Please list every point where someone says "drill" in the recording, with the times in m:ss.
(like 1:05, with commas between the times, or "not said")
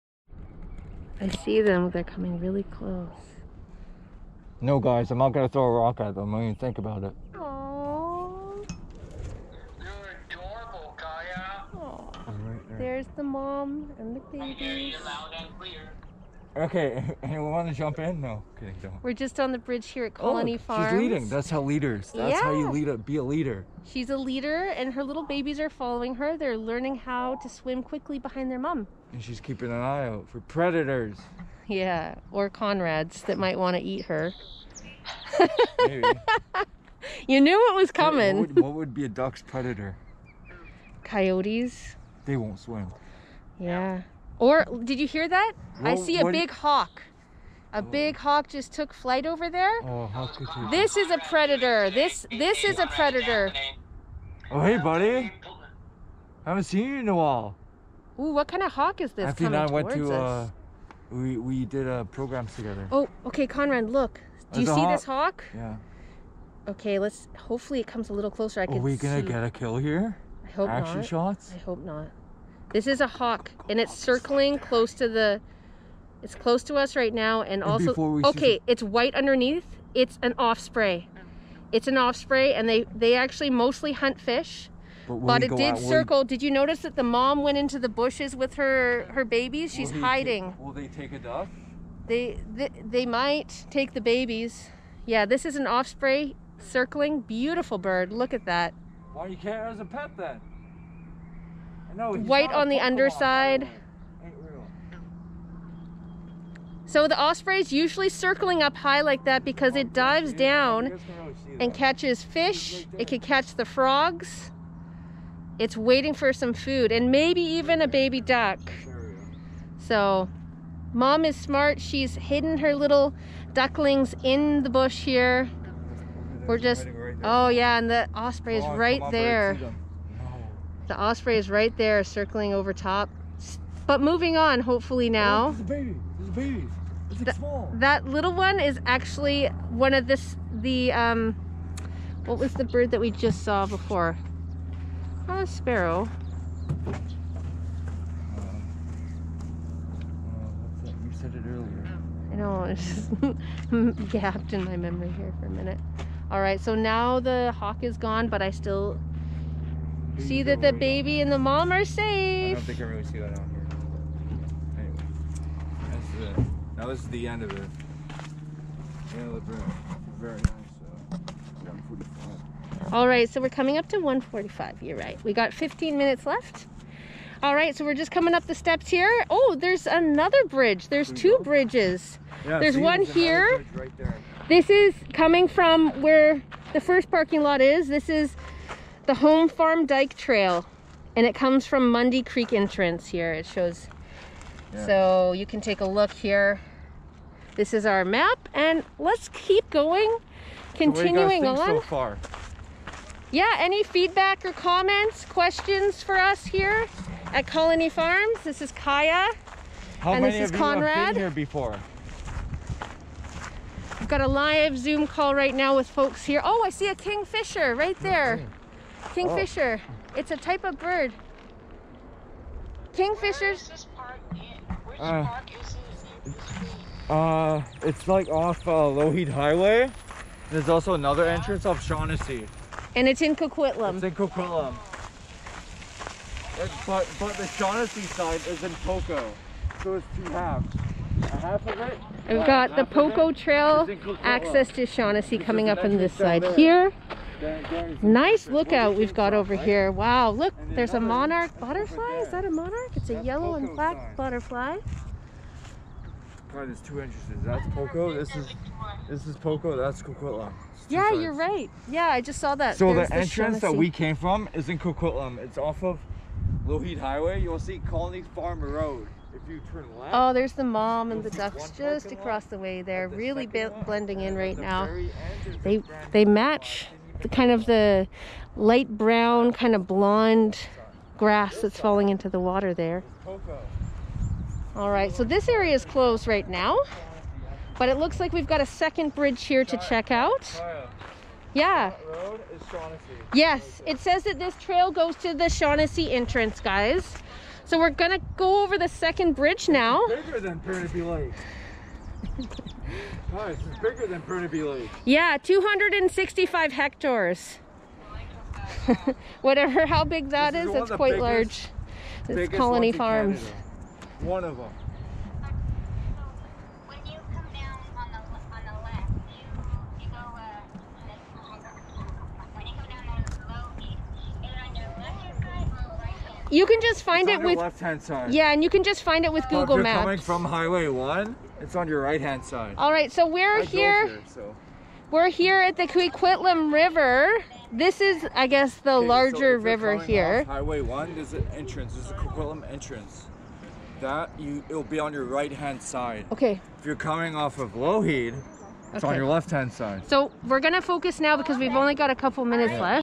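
not said.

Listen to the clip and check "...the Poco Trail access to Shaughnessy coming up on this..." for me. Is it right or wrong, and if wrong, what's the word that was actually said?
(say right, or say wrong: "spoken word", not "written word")
right.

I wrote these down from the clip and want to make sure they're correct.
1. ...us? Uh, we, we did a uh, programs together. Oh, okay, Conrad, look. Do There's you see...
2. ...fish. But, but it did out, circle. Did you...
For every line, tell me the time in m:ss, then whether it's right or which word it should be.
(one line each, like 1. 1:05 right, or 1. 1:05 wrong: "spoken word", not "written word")
1. 1:00 right
2. 1:24 right.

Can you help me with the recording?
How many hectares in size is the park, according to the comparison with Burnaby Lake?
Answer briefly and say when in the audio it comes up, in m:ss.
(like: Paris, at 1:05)
265, at 5:05.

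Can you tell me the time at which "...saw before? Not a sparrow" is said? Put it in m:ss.
2:23.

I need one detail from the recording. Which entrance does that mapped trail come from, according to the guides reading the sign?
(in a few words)
Mundy Creek.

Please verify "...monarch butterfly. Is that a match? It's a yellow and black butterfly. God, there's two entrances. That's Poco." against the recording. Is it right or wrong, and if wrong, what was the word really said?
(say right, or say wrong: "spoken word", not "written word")
wrong: "monarch", not "match".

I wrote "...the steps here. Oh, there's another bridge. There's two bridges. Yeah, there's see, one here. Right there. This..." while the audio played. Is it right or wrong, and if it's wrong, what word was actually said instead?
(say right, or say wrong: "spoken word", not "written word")
right.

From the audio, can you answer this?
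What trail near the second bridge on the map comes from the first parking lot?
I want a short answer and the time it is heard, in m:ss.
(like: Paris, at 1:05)
Home Farm Dike Trail, at 3:09.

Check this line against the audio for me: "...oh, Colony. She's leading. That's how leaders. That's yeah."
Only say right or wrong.
wrong.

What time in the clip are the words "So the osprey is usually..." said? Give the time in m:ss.
1:46.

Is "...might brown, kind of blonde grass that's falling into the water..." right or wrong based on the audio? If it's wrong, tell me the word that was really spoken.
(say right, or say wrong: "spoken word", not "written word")
wrong: "light", not "might".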